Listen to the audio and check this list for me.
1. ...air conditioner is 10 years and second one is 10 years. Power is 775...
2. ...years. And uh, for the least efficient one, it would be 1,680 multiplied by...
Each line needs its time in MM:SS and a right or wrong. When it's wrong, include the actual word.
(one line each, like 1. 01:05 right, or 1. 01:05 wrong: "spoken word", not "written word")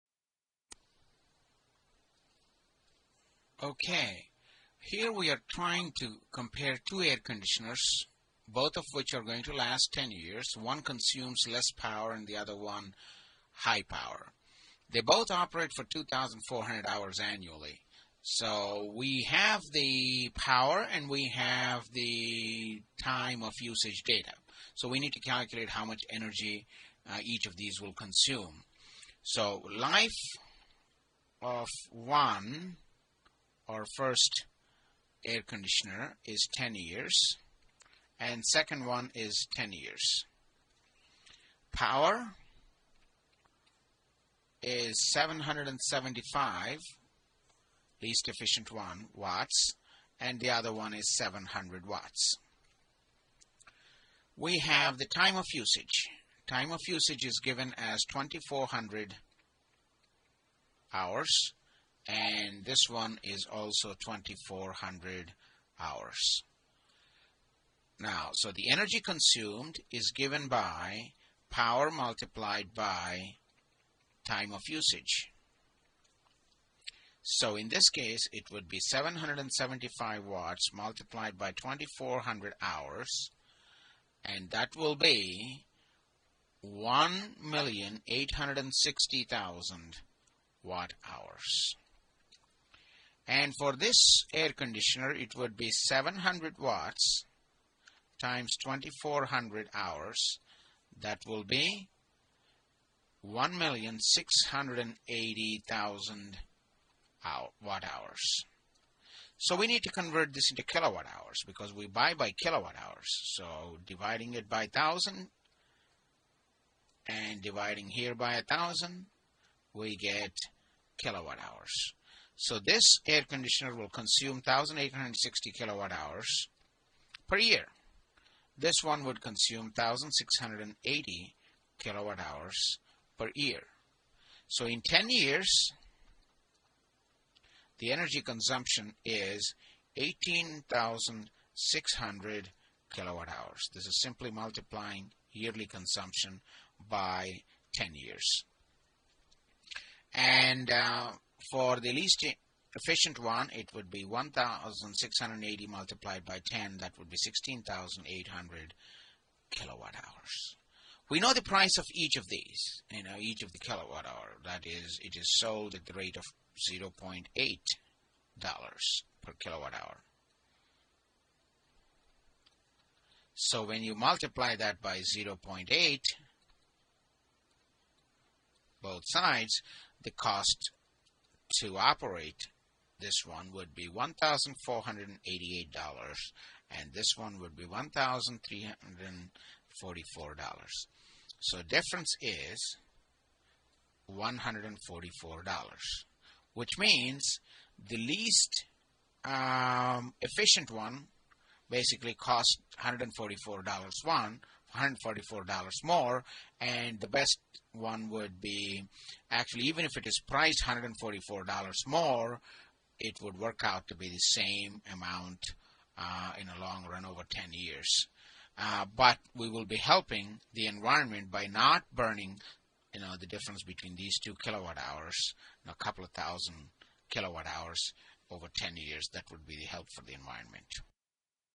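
1. 00:35 right
2. 02:27 right.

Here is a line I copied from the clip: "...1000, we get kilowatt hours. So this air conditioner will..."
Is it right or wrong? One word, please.
right.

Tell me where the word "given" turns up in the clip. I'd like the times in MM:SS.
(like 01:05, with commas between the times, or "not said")
00:57, 01:10.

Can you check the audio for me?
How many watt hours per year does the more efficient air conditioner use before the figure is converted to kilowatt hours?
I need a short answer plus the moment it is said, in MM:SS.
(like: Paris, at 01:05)
1,680,000 watt hours, at 01:43.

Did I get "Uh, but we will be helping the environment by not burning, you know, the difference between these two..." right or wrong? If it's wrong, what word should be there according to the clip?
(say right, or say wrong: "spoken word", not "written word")
right.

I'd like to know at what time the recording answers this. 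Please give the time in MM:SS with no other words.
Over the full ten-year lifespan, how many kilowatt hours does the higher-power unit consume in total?
02:19.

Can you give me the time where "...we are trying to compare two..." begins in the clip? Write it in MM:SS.
00:05.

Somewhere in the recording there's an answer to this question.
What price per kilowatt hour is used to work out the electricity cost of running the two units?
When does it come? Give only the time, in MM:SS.
02:46.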